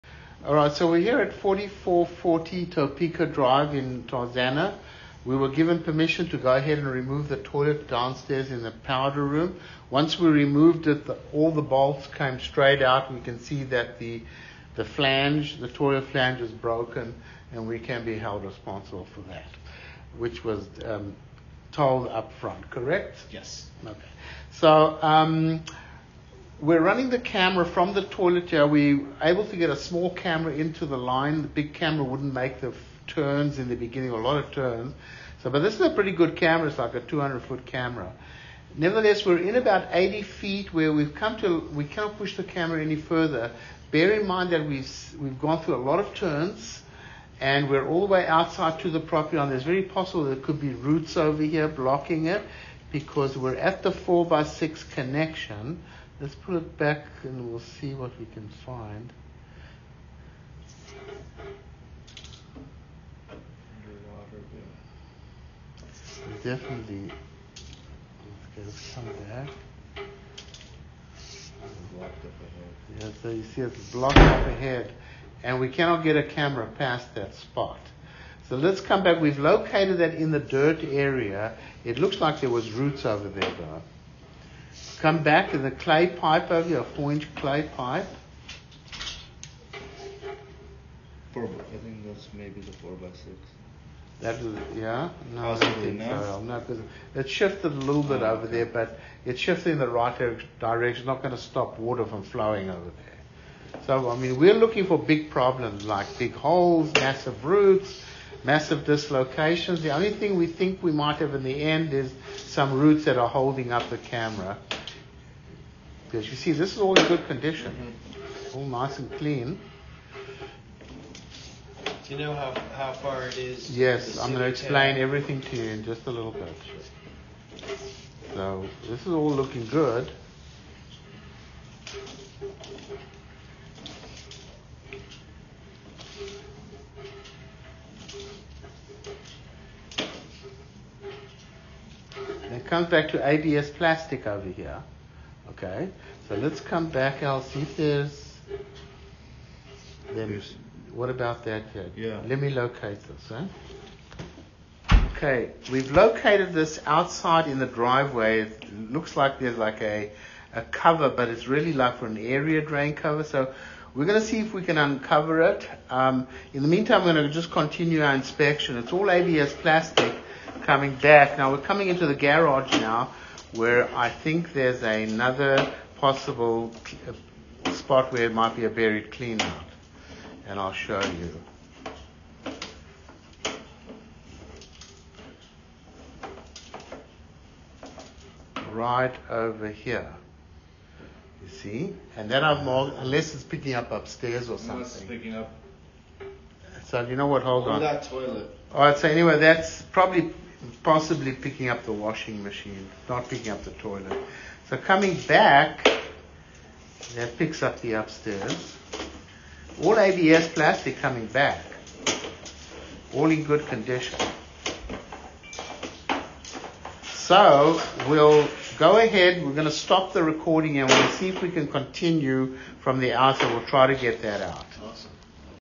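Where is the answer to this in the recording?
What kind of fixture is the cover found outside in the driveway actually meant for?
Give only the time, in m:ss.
2:42.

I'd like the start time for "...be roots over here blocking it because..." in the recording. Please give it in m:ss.
0:50.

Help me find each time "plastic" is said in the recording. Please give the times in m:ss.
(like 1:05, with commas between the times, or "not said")
2:23, 2:49, 3:30.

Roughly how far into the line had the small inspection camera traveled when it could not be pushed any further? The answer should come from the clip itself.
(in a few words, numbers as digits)
80 feet.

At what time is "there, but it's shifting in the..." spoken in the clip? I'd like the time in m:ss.
1:38.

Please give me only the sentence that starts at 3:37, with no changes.
So we'll go ahead, we're going to stop the recording and we'll see if we can continue from the outer.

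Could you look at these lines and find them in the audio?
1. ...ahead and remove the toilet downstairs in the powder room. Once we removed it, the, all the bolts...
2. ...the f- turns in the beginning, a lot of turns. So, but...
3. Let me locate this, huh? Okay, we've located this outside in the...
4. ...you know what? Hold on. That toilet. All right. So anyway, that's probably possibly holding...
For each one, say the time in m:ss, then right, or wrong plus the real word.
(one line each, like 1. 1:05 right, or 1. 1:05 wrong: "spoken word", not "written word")
1. 0:06 right
2. 0:32 right
3. 2:32 right
4. 3:17 wrong: "picking", not "holding".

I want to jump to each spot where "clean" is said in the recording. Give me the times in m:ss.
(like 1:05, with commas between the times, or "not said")
1:59, 2:59.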